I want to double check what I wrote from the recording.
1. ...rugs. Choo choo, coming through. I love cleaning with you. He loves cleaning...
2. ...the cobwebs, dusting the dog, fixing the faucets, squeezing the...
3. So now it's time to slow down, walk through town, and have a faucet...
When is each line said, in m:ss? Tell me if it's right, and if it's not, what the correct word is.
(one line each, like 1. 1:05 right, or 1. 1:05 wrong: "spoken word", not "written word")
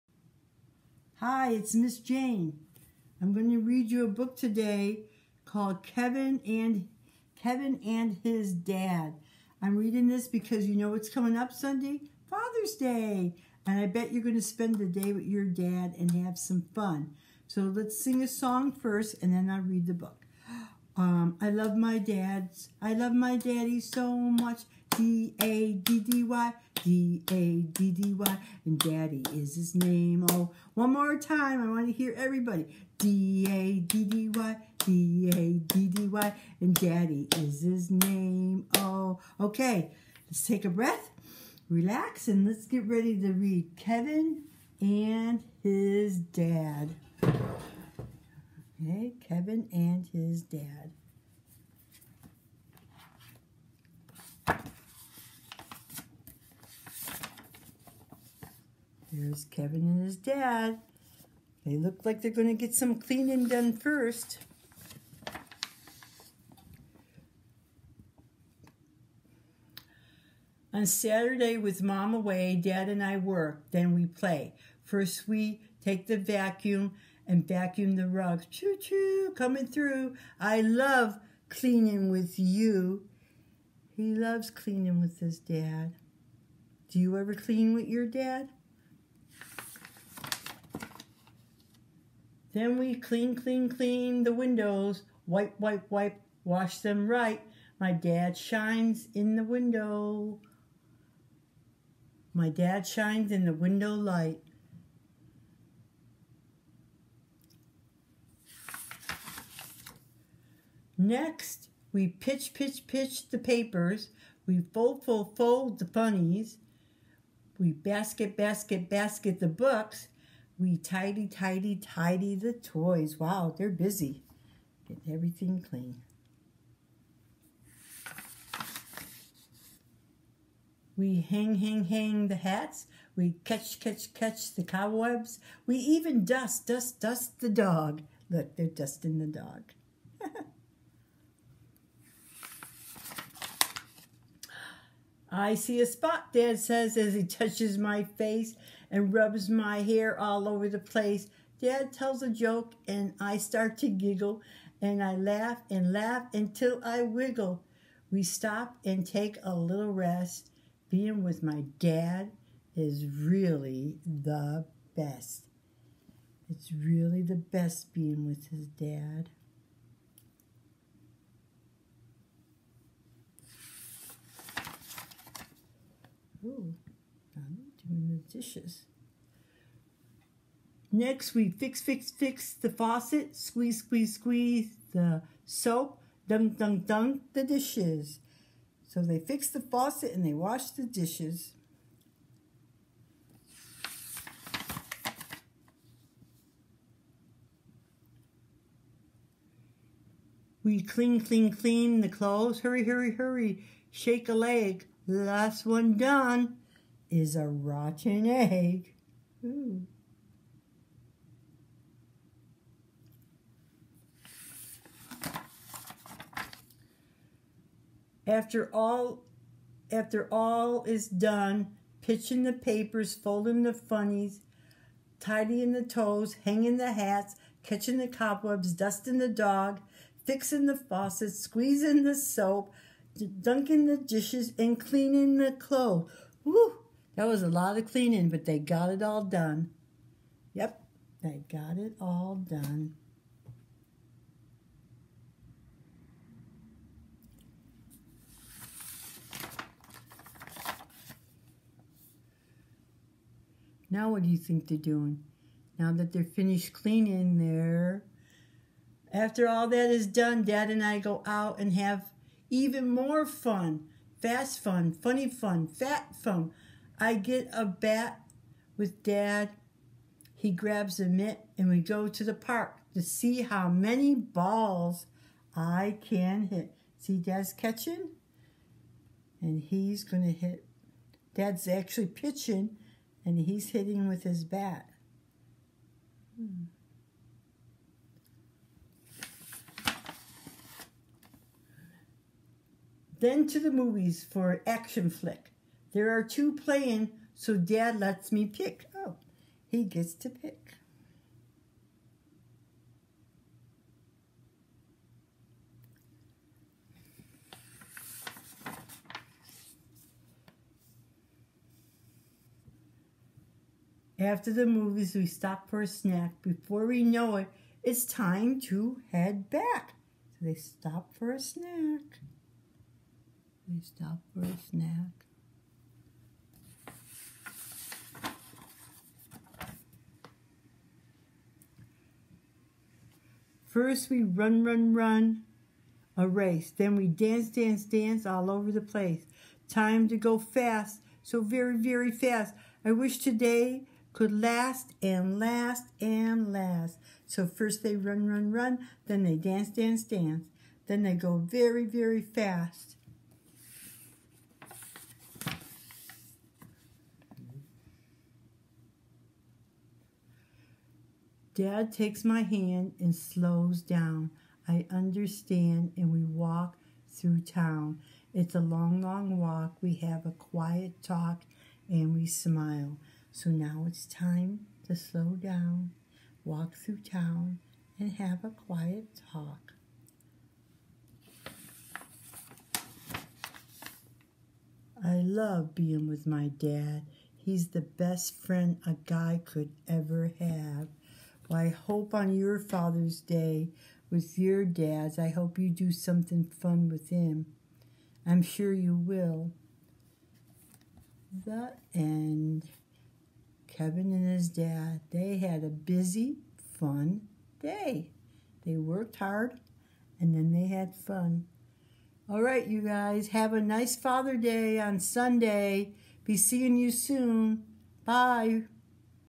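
1. 1:18 right
2. 3:47 right
3. 6:13 wrong: "quiet", not "faucet".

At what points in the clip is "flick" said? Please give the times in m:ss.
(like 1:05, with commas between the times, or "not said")
4:55.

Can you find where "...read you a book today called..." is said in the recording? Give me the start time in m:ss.
0:03.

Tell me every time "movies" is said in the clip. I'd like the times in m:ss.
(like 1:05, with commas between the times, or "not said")
4:53, 5:14.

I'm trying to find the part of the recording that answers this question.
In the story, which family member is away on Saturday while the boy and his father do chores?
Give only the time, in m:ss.
1:11.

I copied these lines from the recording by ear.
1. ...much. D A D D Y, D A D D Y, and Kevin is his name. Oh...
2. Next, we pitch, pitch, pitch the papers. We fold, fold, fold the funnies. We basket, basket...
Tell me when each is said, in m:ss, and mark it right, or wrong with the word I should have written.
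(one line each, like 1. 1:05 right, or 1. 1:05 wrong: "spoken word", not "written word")
1. 0:24 wrong: "Daddy", not "Kevin"
2. 1:50 right.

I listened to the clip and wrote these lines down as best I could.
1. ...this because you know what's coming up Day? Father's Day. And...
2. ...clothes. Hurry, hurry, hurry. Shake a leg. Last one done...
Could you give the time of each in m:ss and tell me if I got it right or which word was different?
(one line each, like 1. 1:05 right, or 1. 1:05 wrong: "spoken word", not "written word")
1. 0:10 wrong: "Sunday", not "Day"
2. 3:22 right.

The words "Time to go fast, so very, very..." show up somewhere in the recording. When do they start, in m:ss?
5:39.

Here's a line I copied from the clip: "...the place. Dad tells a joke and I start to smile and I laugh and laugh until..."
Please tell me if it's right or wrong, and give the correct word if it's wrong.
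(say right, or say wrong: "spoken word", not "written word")
wrong: "giggle", not "smile".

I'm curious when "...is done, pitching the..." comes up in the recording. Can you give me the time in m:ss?
3:40.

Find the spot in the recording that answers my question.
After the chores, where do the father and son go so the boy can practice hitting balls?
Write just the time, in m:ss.
4:32.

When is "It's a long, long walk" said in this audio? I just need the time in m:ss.
6:08.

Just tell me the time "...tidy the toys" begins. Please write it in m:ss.
2:01.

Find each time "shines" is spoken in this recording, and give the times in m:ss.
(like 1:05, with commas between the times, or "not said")
1:38, 1:42.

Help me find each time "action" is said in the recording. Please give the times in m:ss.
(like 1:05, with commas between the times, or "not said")
4:54.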